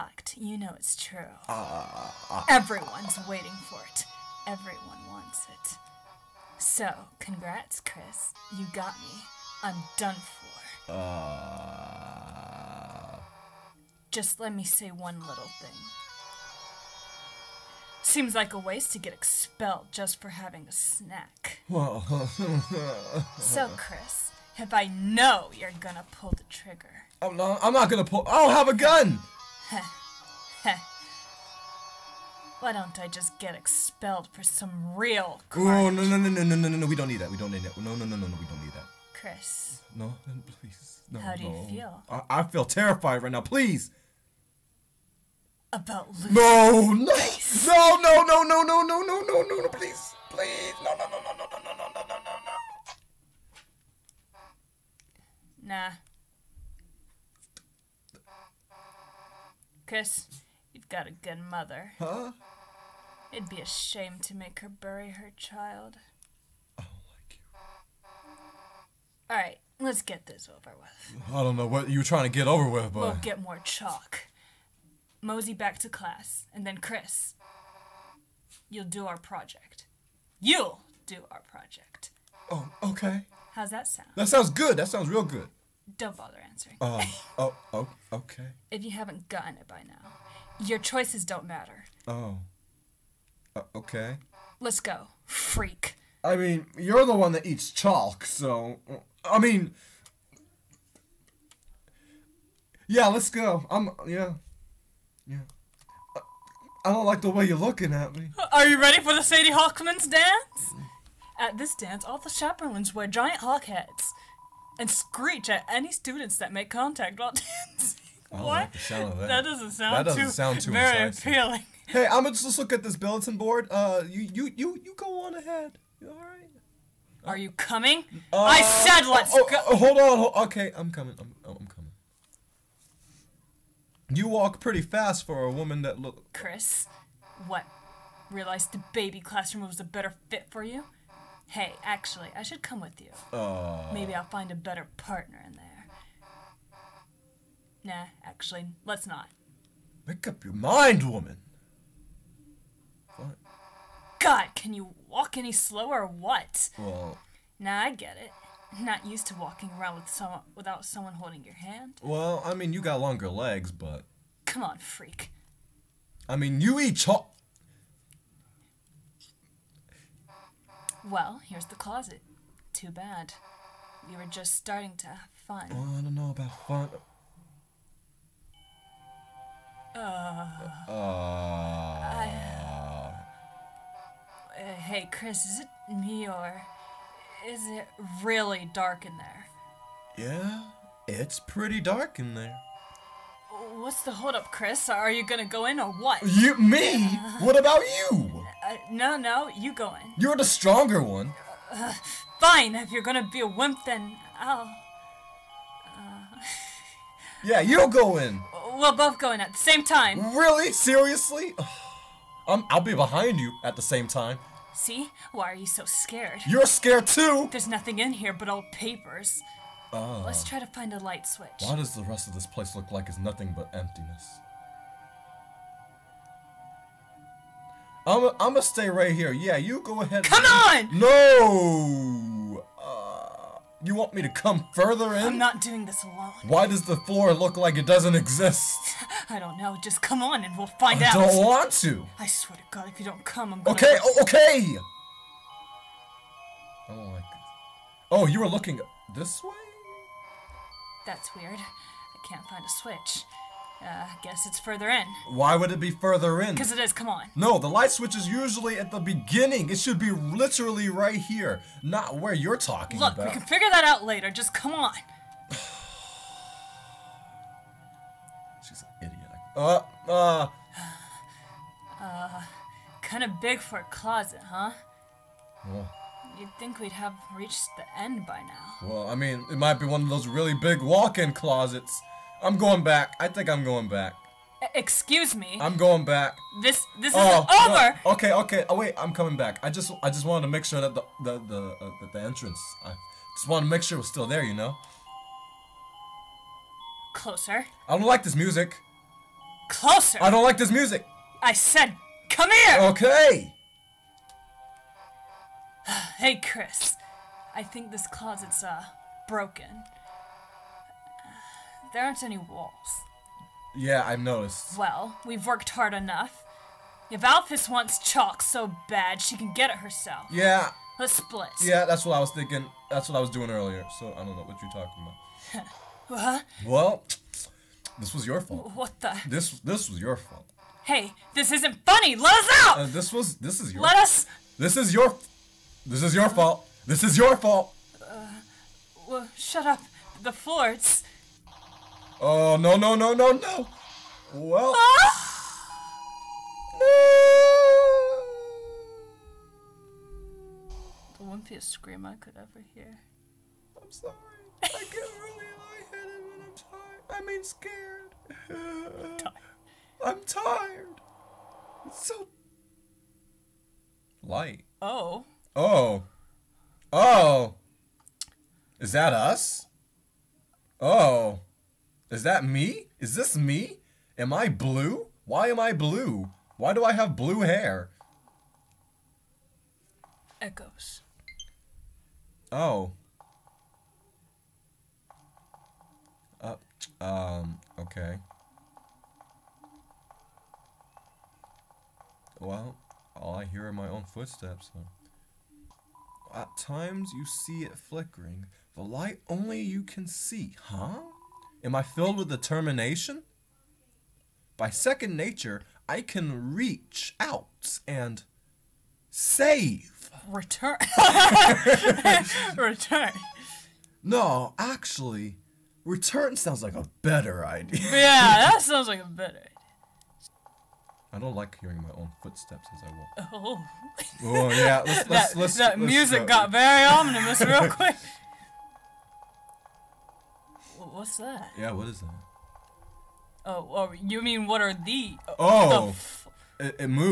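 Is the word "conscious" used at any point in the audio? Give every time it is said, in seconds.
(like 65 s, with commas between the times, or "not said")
not said.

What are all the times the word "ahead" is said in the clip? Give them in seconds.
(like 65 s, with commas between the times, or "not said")
125 s, 230 s.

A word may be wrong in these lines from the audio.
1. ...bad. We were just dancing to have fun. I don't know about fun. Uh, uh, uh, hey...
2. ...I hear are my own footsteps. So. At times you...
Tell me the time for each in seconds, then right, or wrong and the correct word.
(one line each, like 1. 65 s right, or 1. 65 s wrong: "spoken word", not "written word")
1. 172 s wrong: "starting", not "dancing"
2. 393 s right.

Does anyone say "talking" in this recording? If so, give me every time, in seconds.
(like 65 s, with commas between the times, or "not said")
262 s, 324 s.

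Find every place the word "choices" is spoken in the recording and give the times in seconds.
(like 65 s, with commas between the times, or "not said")
90 s.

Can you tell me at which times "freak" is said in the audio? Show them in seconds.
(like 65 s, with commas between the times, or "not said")
95 s, 164 s.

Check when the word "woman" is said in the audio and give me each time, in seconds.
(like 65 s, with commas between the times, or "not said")
135 s, 151 s.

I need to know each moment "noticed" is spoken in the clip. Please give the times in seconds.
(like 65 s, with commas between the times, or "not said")
314 s.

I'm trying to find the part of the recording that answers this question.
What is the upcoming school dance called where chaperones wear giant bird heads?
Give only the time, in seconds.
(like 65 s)
109 s.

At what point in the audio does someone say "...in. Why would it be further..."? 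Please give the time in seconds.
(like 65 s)
254 s.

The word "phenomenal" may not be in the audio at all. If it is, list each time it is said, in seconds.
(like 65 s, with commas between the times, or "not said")
not said.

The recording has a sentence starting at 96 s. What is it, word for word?
I mean, you're the one that eats chalk, so.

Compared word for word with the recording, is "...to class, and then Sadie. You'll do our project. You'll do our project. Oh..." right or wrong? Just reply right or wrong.
wrong.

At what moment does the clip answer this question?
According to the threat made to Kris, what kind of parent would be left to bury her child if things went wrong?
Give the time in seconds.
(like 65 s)
61 s.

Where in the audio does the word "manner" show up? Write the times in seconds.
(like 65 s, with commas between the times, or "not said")
not said.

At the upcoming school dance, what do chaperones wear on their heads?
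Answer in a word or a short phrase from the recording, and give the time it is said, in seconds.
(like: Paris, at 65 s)
giant hawk heads, at 113 s.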